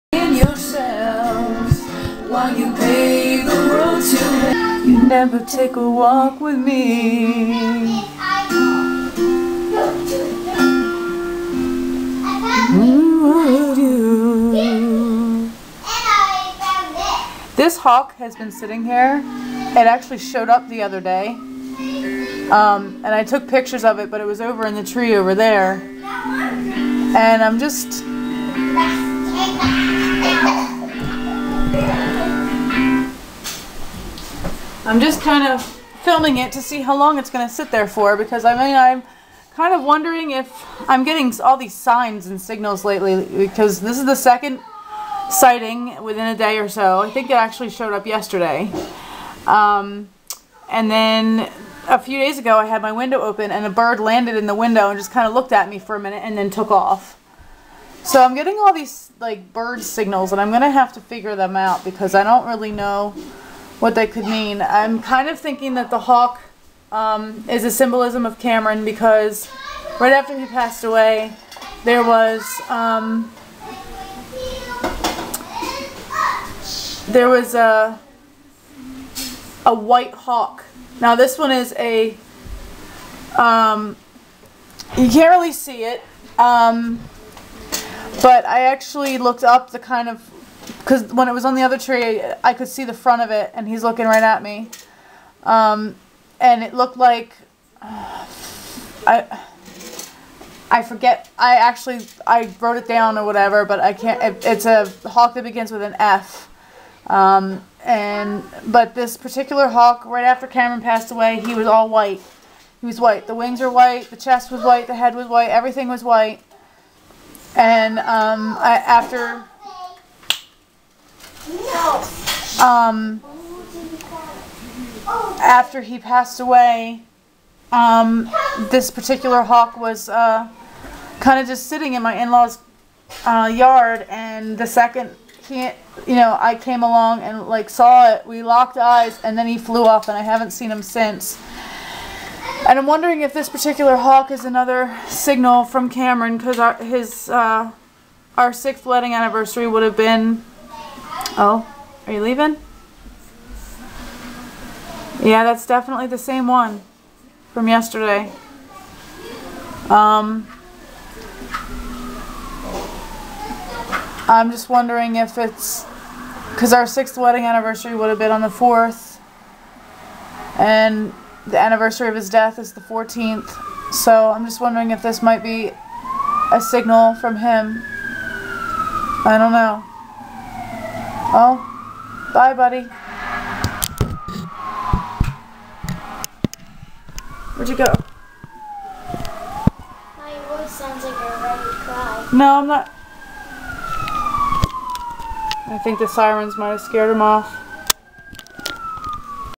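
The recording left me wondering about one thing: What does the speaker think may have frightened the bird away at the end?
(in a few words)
the sirens.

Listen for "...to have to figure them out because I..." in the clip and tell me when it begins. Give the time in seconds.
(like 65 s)
60 s.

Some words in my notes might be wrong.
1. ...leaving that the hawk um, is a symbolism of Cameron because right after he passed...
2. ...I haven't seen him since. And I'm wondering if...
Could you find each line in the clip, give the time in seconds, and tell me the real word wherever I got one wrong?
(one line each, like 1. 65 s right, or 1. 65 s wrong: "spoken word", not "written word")
1. 65 s wrong: "thinking", not "leaving"
2. 140 s right.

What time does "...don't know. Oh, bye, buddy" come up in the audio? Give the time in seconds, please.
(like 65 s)
179 s.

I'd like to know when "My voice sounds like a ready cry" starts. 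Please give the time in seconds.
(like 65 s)
190 s.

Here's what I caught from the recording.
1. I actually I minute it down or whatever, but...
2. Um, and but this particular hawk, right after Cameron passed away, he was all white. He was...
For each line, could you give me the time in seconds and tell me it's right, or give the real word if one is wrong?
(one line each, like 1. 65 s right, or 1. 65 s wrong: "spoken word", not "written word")
1. 101 s wrong: "wrote", not "minute"
2. 107 s right.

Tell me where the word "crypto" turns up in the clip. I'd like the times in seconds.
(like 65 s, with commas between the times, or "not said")
not said.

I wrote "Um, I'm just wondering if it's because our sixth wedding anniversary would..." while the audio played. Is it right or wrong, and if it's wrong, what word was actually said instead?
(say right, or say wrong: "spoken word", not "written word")
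right.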